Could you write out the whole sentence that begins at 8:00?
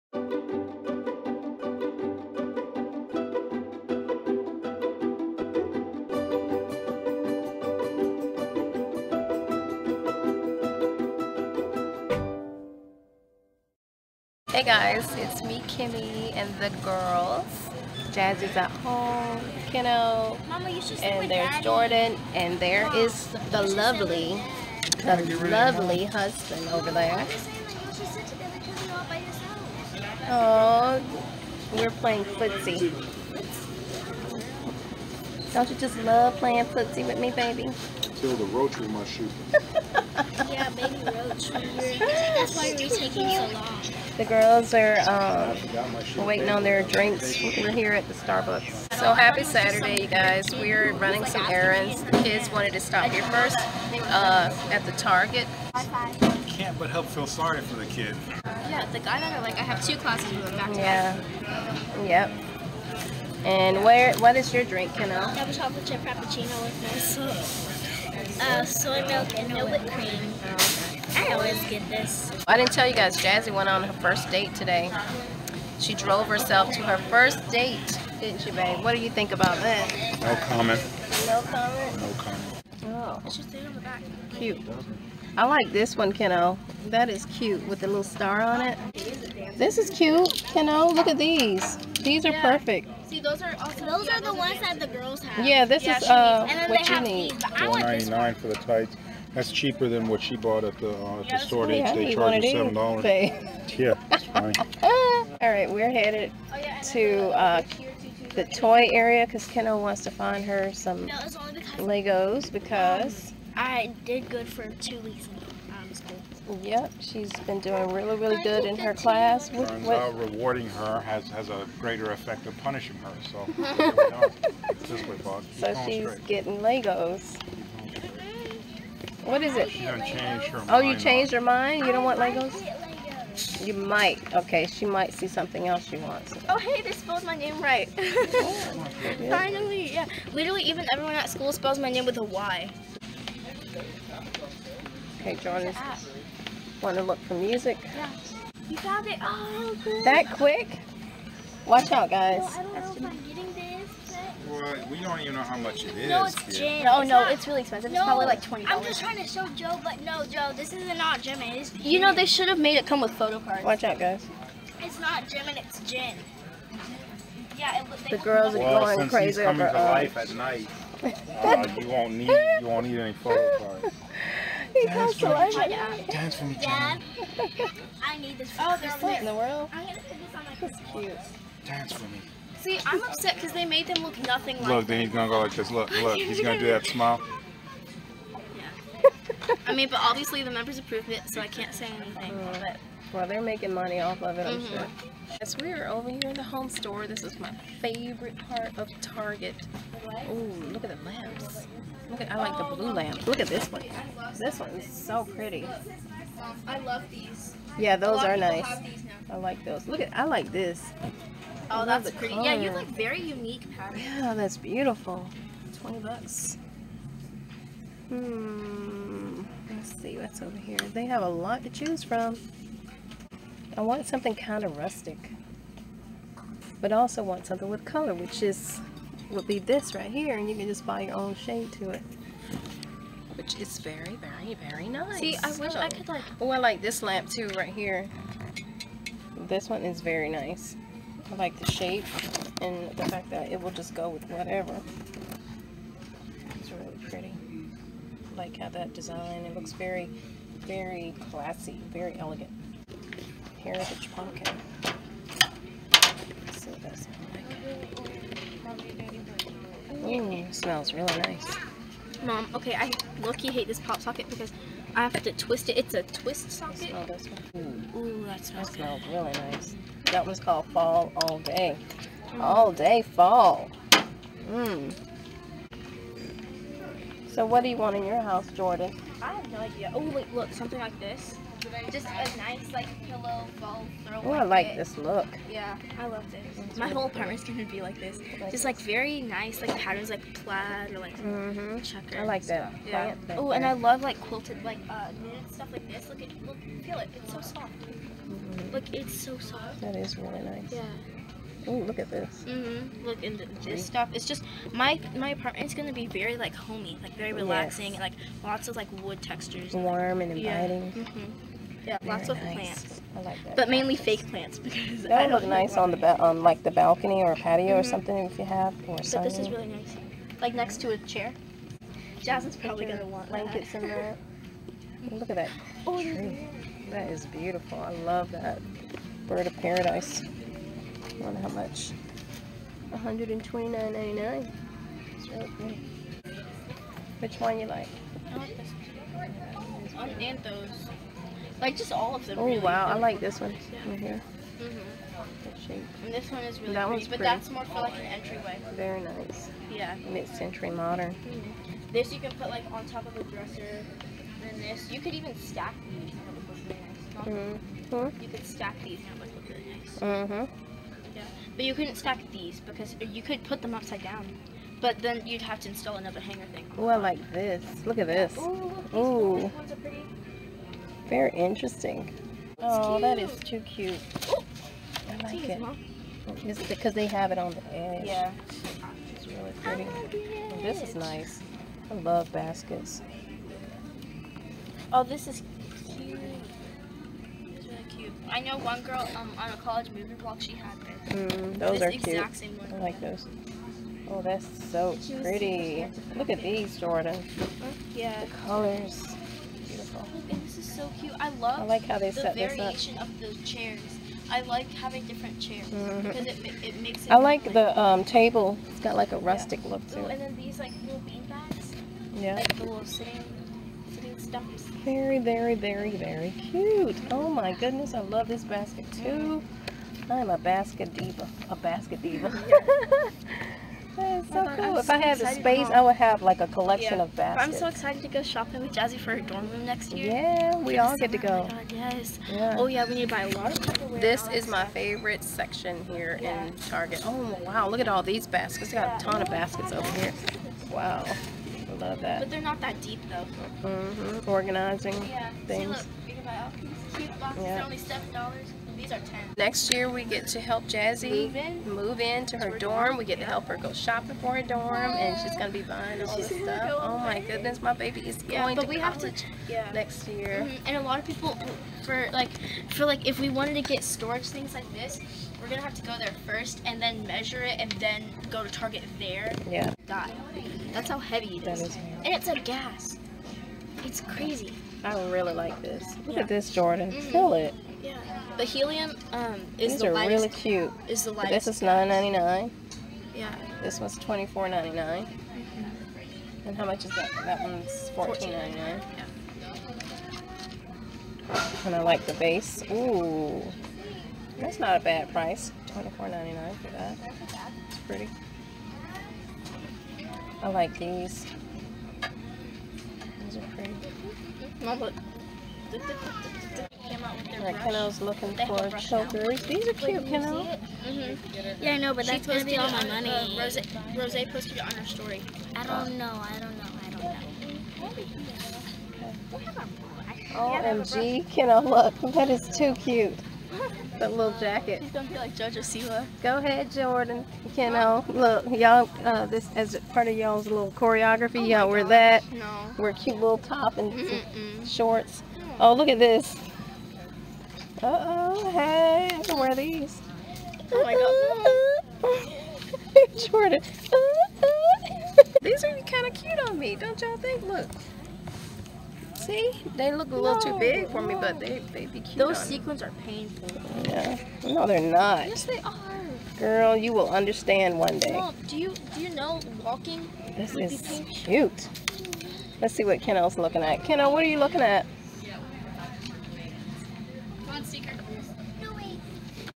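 Is the This is nine ninety nine.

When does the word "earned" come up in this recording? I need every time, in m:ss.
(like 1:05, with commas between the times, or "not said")
not said.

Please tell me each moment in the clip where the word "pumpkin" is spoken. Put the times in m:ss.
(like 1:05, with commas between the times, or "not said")
4:14.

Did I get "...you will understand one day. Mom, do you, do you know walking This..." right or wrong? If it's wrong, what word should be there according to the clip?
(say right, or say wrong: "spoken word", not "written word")
right.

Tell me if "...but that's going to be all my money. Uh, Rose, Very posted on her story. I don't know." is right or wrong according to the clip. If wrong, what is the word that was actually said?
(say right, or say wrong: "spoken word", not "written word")
wrong: "Rose", not "Very".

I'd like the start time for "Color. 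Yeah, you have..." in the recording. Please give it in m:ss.
3:32.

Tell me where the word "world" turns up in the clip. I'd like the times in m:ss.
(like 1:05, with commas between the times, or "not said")
2:59.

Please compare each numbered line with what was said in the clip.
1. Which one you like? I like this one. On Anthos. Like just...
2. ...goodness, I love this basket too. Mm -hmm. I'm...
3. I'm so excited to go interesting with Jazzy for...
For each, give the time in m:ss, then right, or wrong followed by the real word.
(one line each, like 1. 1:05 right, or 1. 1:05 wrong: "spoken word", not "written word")
1. 5:37 right
2. 6:57 right
3. 7:07 wrong: "shopping", not "interesting".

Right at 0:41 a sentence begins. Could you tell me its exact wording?
That's why we're taking so long.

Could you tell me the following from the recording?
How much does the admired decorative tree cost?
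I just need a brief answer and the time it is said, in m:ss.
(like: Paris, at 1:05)
$129.99, at 5:32.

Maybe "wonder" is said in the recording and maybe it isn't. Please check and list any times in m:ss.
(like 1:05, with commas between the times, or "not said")
5:31.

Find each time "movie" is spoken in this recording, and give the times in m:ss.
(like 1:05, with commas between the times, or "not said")
6:29.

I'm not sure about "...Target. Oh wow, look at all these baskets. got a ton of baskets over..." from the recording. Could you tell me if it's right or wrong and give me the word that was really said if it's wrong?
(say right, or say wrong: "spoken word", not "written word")
right.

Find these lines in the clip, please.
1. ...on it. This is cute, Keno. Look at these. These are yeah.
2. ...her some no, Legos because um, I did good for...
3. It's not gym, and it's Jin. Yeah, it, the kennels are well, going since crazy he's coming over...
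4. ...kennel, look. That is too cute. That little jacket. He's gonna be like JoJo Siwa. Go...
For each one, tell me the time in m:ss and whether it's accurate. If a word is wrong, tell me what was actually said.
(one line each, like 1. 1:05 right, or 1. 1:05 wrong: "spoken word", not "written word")
1. 1:28 right
2. 1:50 right
3. 2:44 wrong: "girls", not "kennels"
4. 8:41 right.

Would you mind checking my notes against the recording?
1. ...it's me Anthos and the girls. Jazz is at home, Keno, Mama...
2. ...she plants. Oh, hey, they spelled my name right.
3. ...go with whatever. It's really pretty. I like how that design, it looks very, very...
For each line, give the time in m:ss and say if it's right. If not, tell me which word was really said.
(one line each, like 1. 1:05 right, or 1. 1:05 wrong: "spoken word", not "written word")
1. 0:15 wrong: "Kimmy", not "Anthos"
2. 2:15 wrong: "wants", not "plants"
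3. 4:03 right.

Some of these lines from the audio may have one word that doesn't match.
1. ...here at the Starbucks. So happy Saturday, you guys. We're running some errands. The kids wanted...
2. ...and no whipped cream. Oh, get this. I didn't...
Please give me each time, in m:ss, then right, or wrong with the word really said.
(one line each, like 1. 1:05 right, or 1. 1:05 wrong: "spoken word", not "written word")
1. 0:47 right
2. 1:09 right.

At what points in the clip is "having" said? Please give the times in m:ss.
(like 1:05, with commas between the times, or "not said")
6:44.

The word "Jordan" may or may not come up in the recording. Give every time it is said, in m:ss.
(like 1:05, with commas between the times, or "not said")
0:21, 2:25, 4:38, 6:36, 7:56, 8:46, 9:03.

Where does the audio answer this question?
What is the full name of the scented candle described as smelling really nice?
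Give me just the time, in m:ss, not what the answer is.
4:30.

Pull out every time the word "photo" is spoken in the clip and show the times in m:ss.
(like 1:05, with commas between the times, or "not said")
2:43, 2:53.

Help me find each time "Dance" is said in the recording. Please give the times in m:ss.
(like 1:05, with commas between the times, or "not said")
2:56, 3:01.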